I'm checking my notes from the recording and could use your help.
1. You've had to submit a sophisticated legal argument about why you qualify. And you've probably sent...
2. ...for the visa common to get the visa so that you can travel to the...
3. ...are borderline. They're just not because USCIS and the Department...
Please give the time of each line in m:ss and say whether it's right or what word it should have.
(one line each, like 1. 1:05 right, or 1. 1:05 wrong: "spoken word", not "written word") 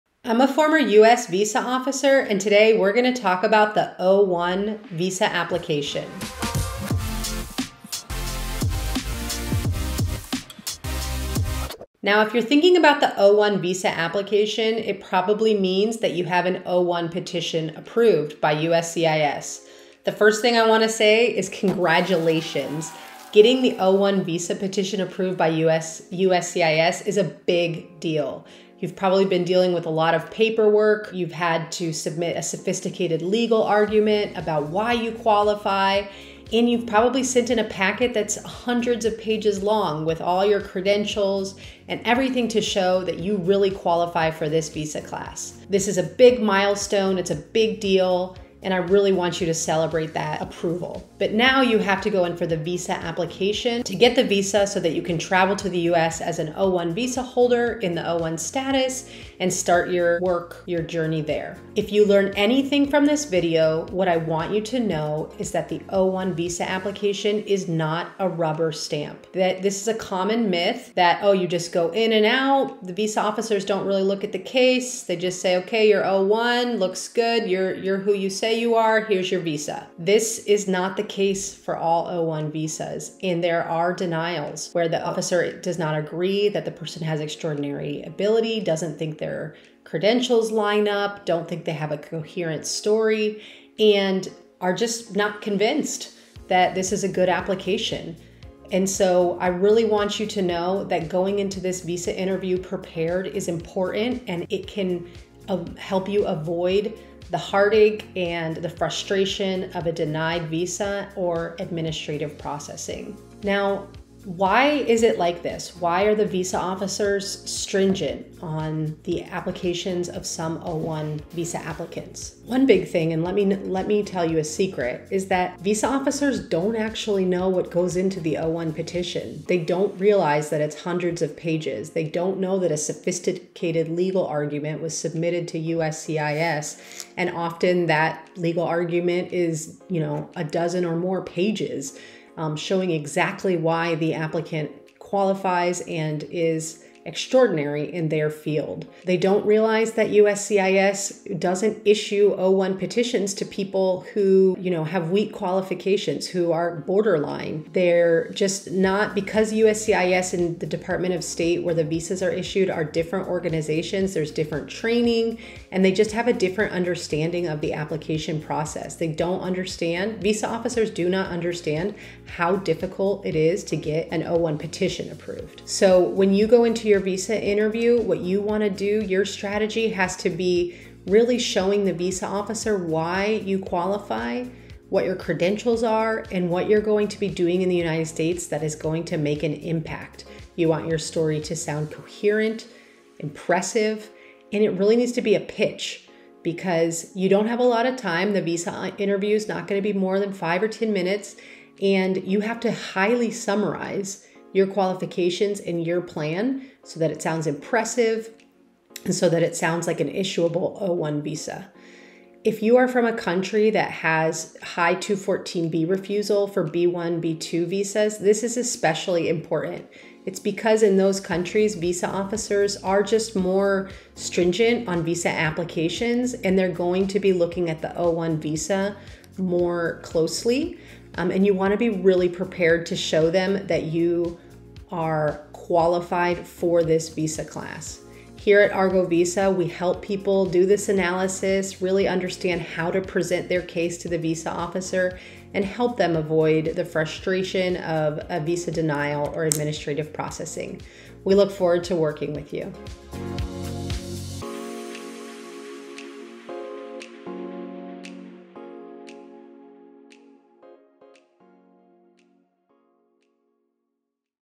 1. 0:31 right
2. 0:52 wrong: "application", not "common"
3. 2:36 right.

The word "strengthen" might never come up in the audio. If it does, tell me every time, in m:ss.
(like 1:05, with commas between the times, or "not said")
not said.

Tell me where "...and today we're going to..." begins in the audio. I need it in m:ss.
0:02.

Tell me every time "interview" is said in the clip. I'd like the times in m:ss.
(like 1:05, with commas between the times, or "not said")
1:42, 2:57, 3:18.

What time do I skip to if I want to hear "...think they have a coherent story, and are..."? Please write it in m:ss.
1:31.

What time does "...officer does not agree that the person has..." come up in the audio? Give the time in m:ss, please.
1:25.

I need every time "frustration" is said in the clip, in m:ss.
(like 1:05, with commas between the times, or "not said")
1:48, 4:06.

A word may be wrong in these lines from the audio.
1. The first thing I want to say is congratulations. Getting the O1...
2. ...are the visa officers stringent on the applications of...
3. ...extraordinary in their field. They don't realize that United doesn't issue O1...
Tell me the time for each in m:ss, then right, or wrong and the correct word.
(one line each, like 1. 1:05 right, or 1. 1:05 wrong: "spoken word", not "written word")
1. 0:20 right
2. 1:56 right
3. 2:27 wrong: "USCIS", not "United".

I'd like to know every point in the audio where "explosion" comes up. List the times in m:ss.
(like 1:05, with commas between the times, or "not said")
not said.